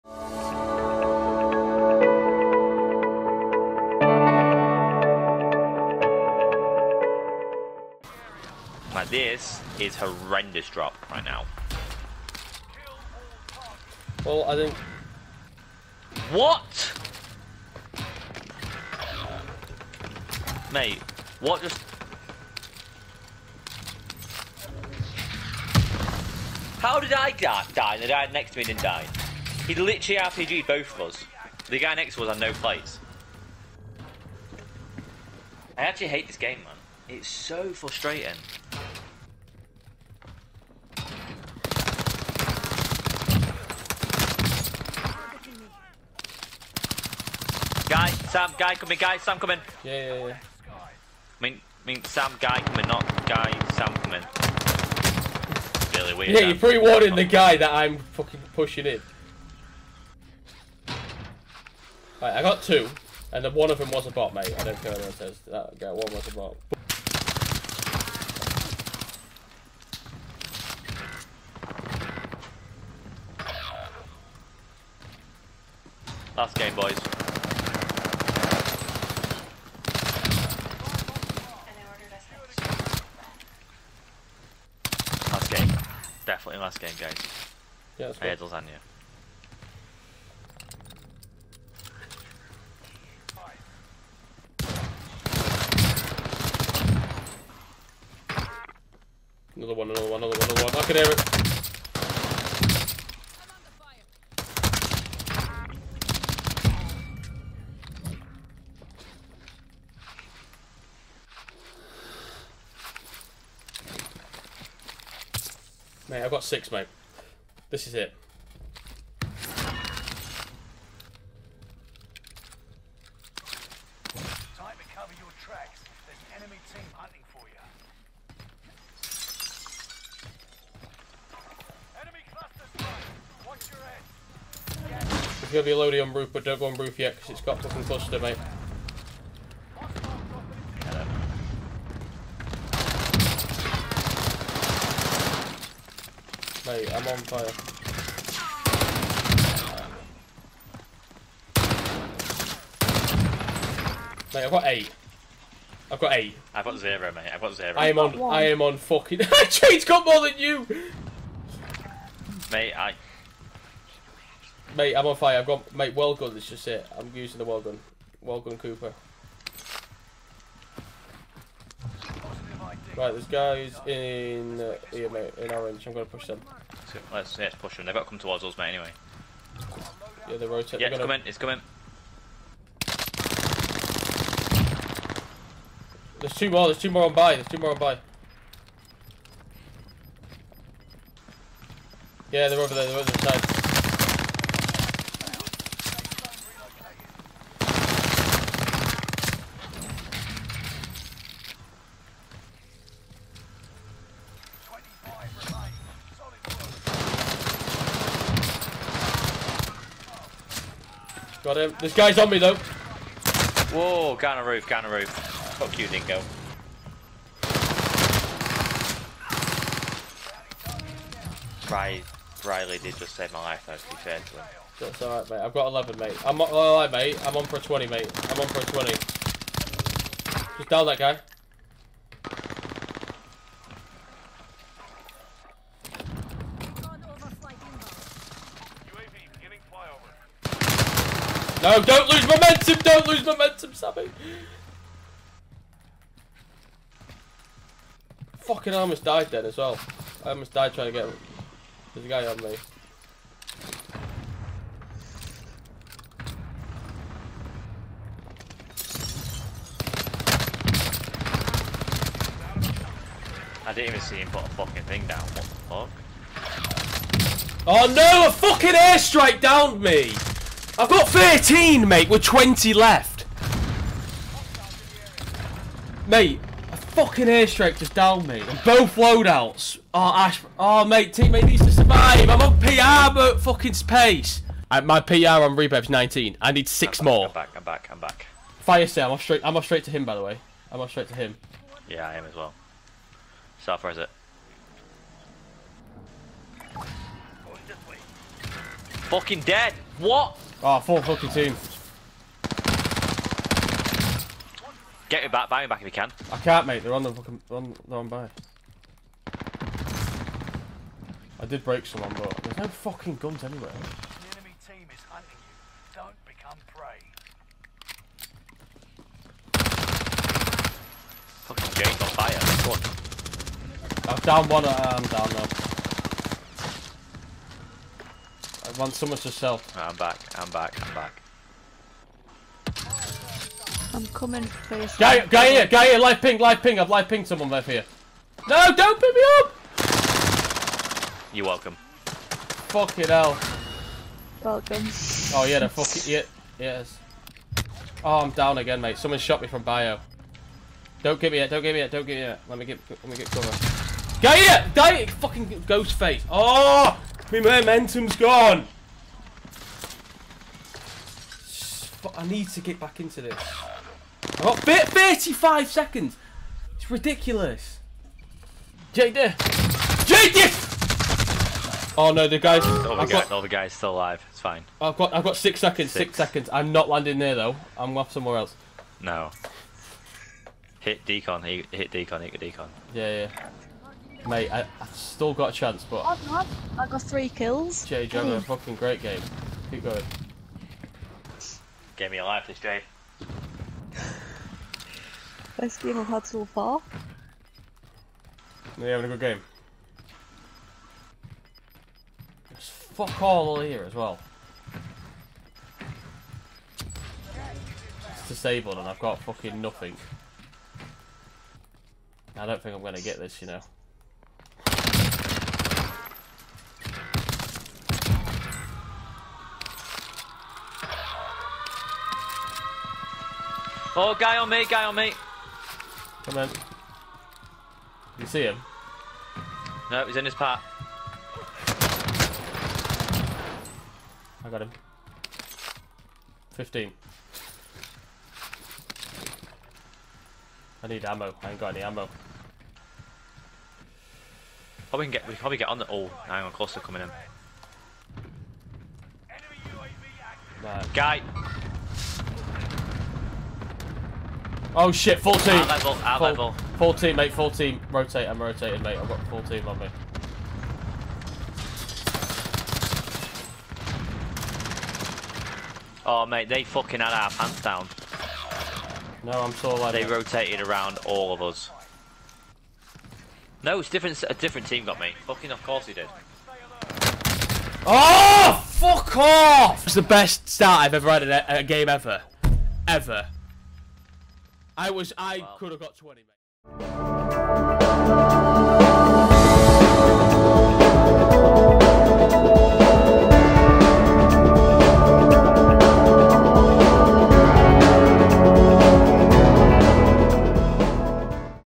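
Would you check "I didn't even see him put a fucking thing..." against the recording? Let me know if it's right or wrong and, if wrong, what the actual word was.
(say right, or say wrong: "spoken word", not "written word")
right.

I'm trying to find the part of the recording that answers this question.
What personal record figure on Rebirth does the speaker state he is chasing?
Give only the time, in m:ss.
4:45.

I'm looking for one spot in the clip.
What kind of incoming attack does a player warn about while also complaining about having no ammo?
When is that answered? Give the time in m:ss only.
7:26.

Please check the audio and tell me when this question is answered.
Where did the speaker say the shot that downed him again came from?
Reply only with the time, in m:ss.
5:49.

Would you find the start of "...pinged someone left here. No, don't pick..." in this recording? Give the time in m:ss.
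5:37.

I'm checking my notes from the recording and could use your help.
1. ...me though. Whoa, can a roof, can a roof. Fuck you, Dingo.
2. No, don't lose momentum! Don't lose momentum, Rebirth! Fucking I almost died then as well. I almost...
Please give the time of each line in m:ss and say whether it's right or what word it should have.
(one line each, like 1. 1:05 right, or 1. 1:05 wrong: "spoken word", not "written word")
1. 3:32 right
2. 4:01 wrong: "Sammy", not "Rebirth".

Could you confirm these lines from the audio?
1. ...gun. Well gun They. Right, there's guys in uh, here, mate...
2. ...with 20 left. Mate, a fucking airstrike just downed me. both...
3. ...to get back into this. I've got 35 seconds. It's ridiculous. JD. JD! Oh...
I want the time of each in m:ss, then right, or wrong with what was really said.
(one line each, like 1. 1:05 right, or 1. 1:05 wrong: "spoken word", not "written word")
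1. 2:47 wrong: "Cooper", not "They"
2. 4:32 right
3. 6:02 right.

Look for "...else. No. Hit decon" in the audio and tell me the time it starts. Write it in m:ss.
6:18.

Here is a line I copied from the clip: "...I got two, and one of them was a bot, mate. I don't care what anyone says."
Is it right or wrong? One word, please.
right.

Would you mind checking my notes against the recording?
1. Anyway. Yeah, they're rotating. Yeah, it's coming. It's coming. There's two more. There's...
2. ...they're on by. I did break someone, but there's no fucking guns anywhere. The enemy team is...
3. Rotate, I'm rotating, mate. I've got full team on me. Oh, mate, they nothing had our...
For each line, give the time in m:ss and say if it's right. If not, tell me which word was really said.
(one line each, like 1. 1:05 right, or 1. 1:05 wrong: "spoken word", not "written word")
1. 2:58 right
2. 5:07 right
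3. 7:37 wrong: "fucking", not "nothing".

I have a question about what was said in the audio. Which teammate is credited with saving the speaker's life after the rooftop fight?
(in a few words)
Riley.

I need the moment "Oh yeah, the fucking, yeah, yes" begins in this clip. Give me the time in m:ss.
5:45.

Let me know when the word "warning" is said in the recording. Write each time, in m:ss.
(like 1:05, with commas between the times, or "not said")
0:56.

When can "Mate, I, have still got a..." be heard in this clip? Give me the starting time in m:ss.
6:24.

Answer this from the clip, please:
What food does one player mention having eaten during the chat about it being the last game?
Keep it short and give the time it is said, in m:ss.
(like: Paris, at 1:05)
lasagna, at 1:28.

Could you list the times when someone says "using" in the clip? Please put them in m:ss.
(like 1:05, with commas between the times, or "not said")
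2:47.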